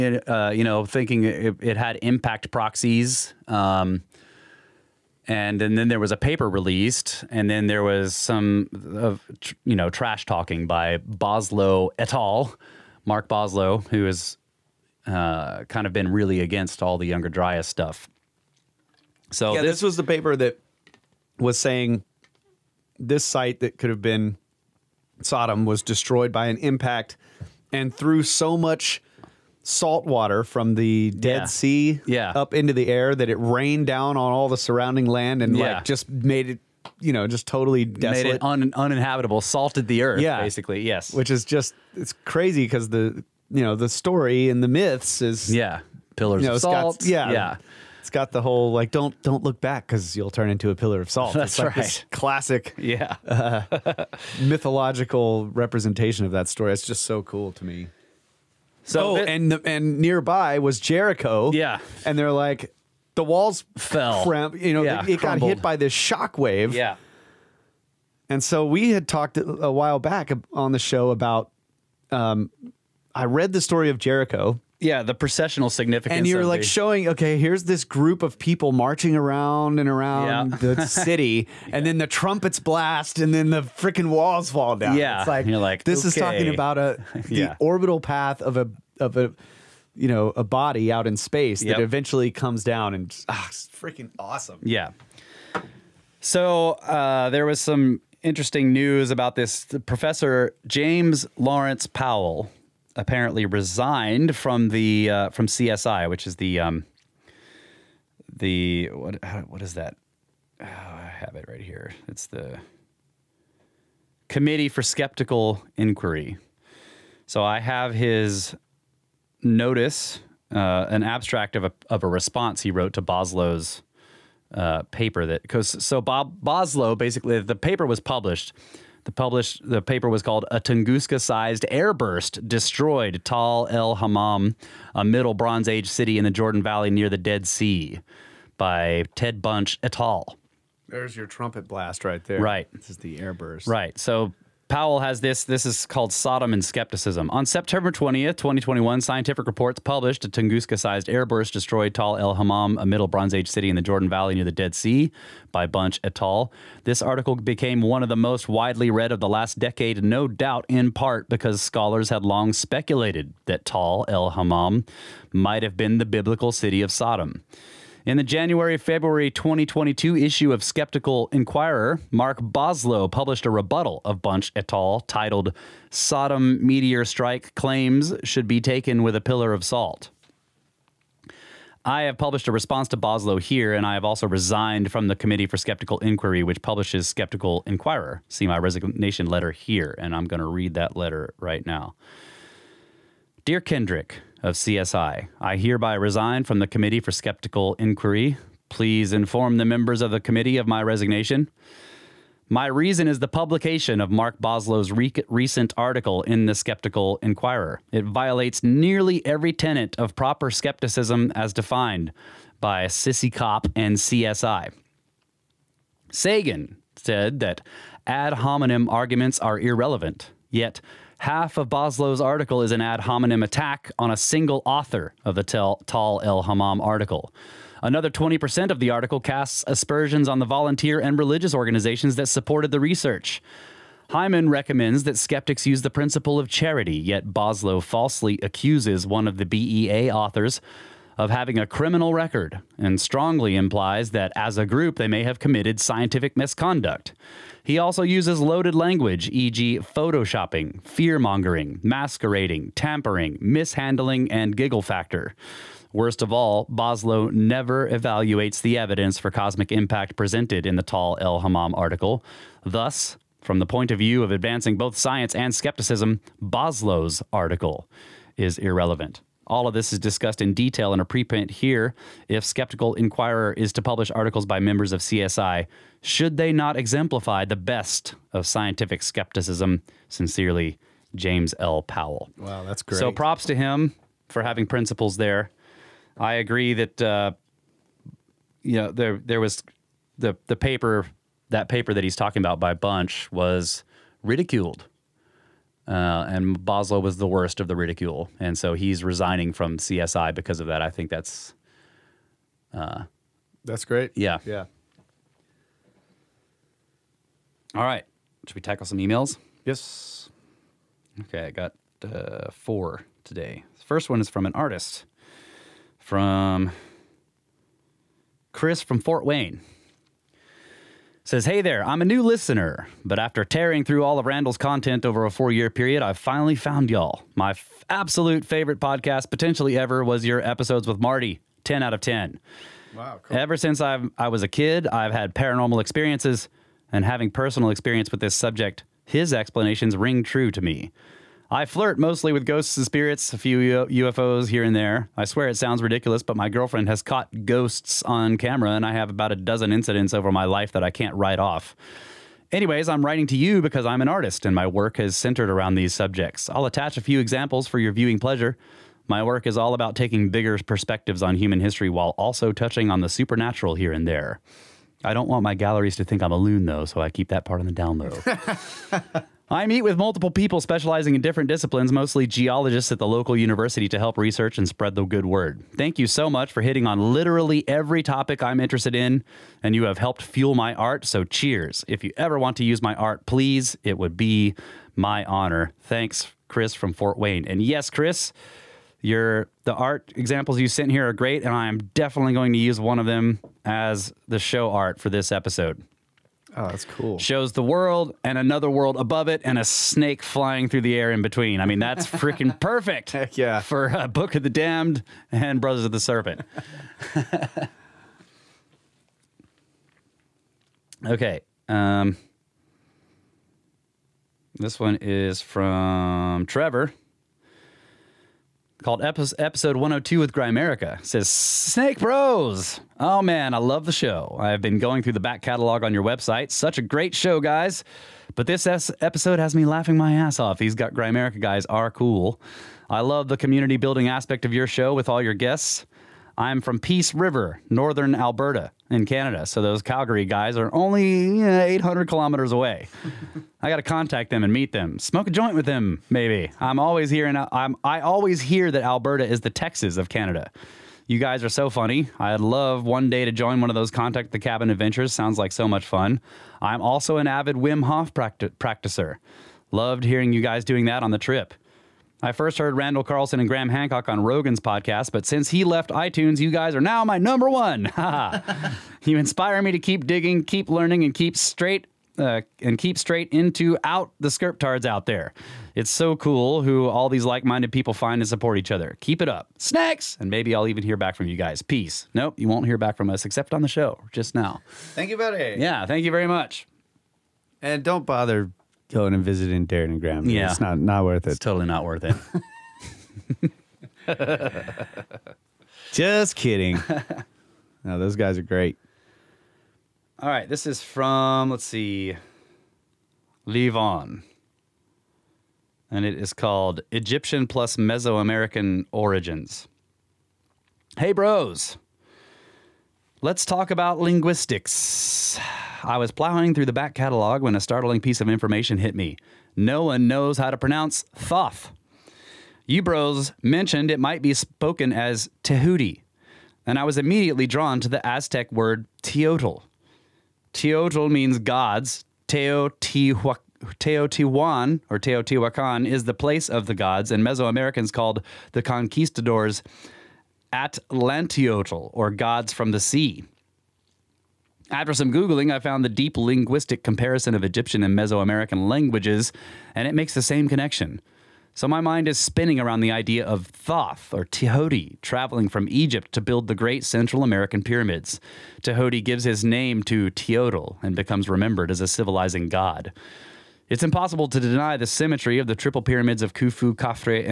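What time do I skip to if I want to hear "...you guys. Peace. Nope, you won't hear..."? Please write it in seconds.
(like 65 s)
481 s.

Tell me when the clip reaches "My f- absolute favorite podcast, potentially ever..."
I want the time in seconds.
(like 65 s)
327 s.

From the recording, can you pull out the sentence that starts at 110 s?
Oh, I have it right here.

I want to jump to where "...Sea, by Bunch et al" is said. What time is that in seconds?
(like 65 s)
154 s.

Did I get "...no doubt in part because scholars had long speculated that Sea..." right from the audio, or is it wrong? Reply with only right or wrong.
wrong.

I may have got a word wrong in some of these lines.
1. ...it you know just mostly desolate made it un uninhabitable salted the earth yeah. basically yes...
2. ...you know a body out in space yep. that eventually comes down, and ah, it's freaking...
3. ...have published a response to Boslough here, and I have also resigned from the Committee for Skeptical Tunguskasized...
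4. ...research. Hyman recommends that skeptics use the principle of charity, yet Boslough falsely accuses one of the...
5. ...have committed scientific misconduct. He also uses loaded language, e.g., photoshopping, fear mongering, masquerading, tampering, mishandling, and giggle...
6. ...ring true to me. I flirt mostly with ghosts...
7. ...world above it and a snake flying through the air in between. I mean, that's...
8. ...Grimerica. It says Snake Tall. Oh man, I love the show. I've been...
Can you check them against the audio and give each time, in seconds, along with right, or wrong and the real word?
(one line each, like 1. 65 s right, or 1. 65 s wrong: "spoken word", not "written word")
1. 36 s wrong: "totally", not "mostly"
2. 89 s right
3. 182 s wrong: "Inquiry", not "Tunguskasized"
4. 232 s right
5. 245 s right
6. 339 s right
7. 398 s right
8. 420 s wrong: "Bros", not "Tall".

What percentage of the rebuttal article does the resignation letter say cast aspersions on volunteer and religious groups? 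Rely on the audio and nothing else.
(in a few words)
20%.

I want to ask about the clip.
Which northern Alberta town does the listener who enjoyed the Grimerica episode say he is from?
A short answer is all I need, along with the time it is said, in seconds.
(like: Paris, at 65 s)
Peace River, at 436 s.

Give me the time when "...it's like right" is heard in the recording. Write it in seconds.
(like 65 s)
51 s.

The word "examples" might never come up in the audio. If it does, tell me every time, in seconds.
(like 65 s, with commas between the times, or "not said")
357 s, 390 s.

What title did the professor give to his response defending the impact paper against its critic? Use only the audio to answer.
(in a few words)
Sodom and Skepticism.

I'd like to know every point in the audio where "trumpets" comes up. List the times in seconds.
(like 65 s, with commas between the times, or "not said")
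82 s, 141 s.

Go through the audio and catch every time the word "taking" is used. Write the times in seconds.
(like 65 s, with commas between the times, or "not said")
359 s.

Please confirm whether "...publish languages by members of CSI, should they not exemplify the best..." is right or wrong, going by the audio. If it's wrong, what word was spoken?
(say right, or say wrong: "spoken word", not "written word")
wrong: "articles", not "languages".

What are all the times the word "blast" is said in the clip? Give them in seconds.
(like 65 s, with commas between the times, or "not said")
82 s, 141 s.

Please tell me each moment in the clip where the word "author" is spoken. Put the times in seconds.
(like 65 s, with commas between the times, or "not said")
224 s, 240 s.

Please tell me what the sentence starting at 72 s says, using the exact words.
Um, I read the story of Jericho yeah, the processional significance.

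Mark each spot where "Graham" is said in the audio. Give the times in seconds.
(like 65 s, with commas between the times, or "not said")
463 s, 489 s.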